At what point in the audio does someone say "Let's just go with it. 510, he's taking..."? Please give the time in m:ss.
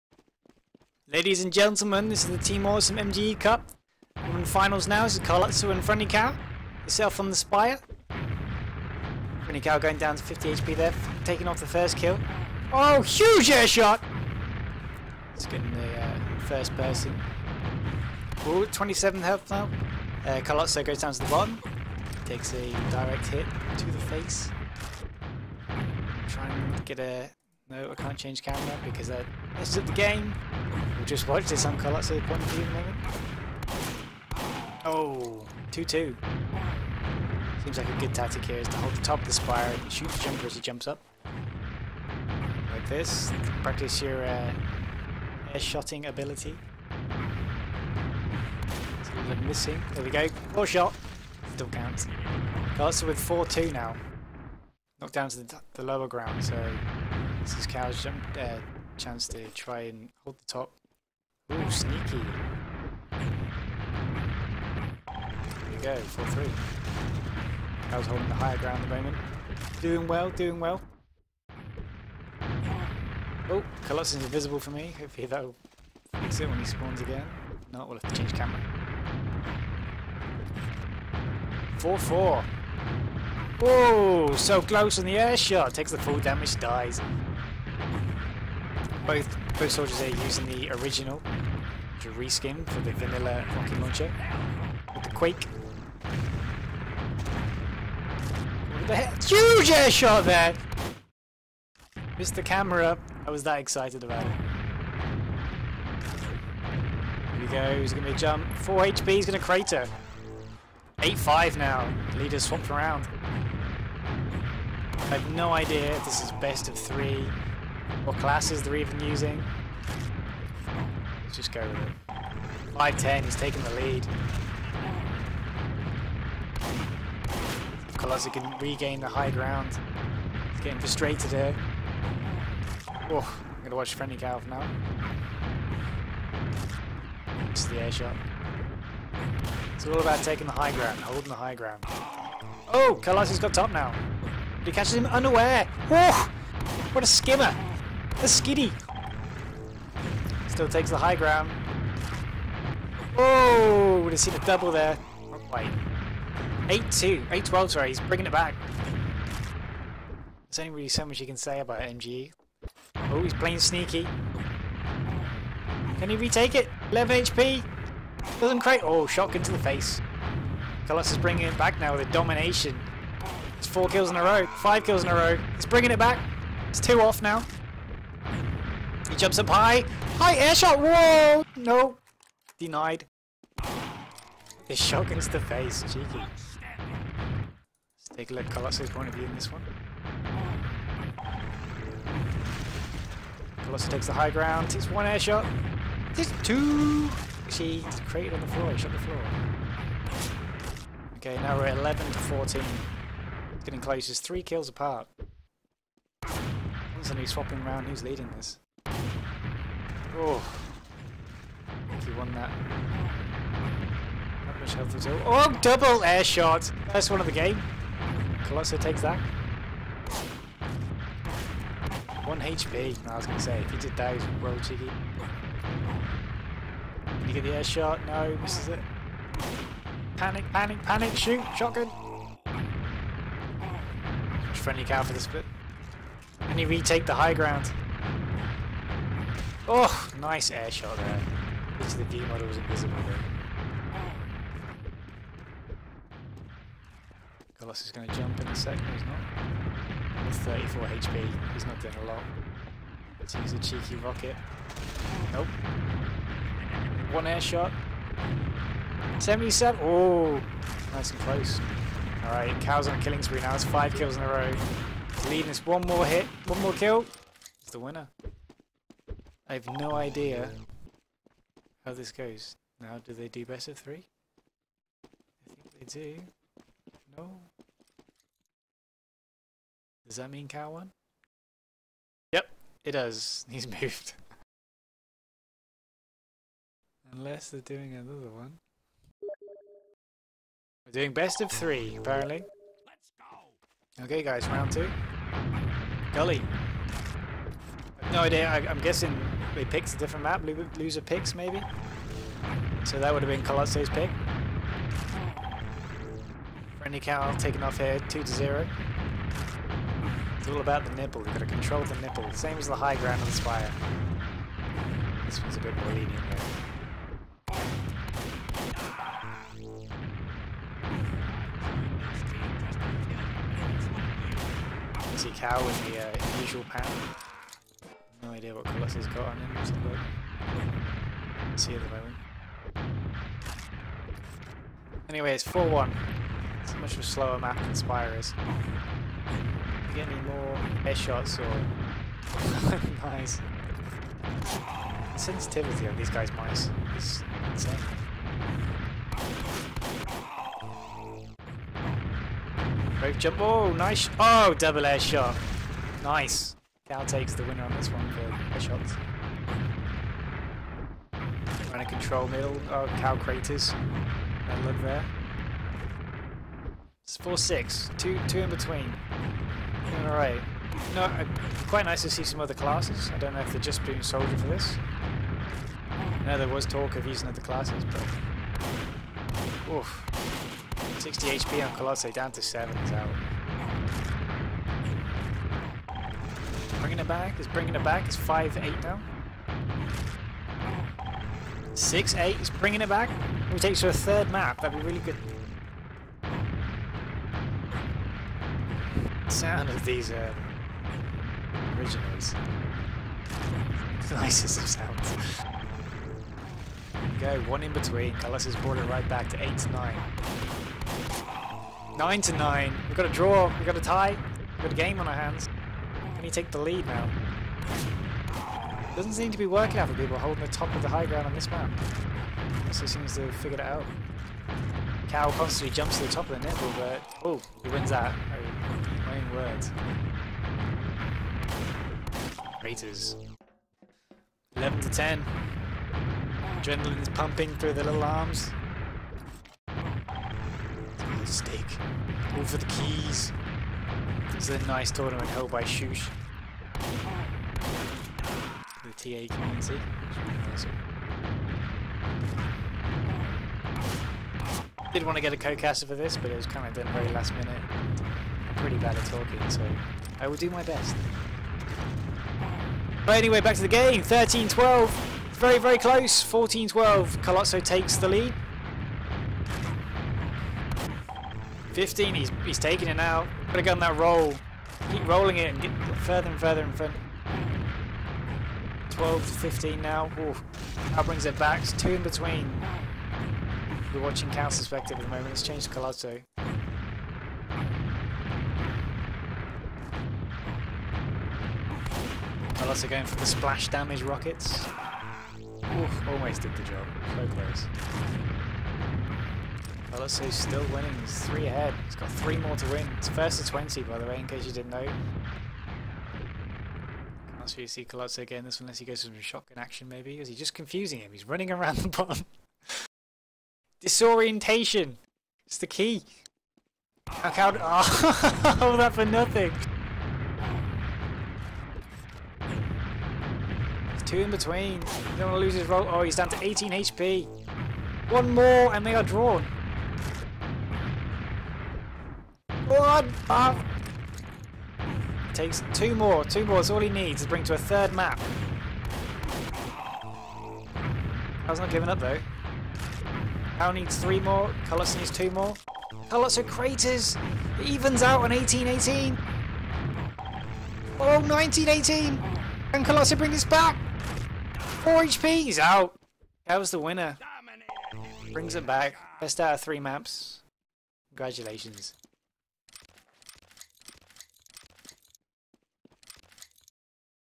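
2:01.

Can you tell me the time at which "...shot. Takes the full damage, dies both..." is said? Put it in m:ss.
1:25.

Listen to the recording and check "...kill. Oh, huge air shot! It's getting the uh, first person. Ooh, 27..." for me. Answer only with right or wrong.
right.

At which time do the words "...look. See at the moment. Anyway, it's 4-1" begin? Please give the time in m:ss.
5:29.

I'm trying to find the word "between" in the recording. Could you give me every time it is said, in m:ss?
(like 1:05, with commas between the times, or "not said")
6:08, 6:47, 8:02, 8:44.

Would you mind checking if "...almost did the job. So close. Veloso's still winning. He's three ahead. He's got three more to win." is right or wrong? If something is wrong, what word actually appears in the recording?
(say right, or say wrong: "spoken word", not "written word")
right.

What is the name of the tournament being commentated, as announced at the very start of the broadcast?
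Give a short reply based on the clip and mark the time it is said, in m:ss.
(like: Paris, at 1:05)
Team Awesome MGE Cup, at 0:02.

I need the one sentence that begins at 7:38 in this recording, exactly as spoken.
I'm pretty bad at talking, so I will do my best.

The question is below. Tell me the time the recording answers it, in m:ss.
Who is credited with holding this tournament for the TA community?
7:25.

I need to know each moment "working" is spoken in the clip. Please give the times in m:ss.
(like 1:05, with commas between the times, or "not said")
6:59.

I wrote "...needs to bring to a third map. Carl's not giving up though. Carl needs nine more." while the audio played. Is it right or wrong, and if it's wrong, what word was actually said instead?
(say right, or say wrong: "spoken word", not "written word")
wrong: "three", not "nine".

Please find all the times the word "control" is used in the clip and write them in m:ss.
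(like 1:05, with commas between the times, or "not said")
5:11, 6:01.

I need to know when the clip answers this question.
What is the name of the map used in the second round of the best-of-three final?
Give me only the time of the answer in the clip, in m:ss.
4:56.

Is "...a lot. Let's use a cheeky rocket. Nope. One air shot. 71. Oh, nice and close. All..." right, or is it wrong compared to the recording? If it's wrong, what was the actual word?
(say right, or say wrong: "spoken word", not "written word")
wrong: "77", not "71".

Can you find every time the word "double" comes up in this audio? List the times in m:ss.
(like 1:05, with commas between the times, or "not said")
2:34, 3:35, 5:54.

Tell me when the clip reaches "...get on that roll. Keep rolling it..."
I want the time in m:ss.
7:53.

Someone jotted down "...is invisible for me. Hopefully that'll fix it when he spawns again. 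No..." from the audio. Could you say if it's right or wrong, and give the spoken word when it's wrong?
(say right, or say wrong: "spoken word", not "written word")
right.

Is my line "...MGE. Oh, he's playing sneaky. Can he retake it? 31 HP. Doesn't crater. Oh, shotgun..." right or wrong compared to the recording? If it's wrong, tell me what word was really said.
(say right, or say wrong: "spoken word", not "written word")
wrong: "11", not "31".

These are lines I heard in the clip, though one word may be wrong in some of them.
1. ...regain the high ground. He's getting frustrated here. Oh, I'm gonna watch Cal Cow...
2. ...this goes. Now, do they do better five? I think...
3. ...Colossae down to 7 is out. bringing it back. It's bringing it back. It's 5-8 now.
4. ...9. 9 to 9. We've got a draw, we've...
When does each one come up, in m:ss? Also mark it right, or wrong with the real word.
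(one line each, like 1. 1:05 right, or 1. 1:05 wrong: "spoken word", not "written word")
1. 2:08 wrong: "Friendly", not "Cal"
2. 4:31 wrong: "three", not "five"
3. 6:21 right
4. 6:49 right.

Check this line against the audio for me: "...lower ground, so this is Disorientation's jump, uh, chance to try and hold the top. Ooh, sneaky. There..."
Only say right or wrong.
wrong.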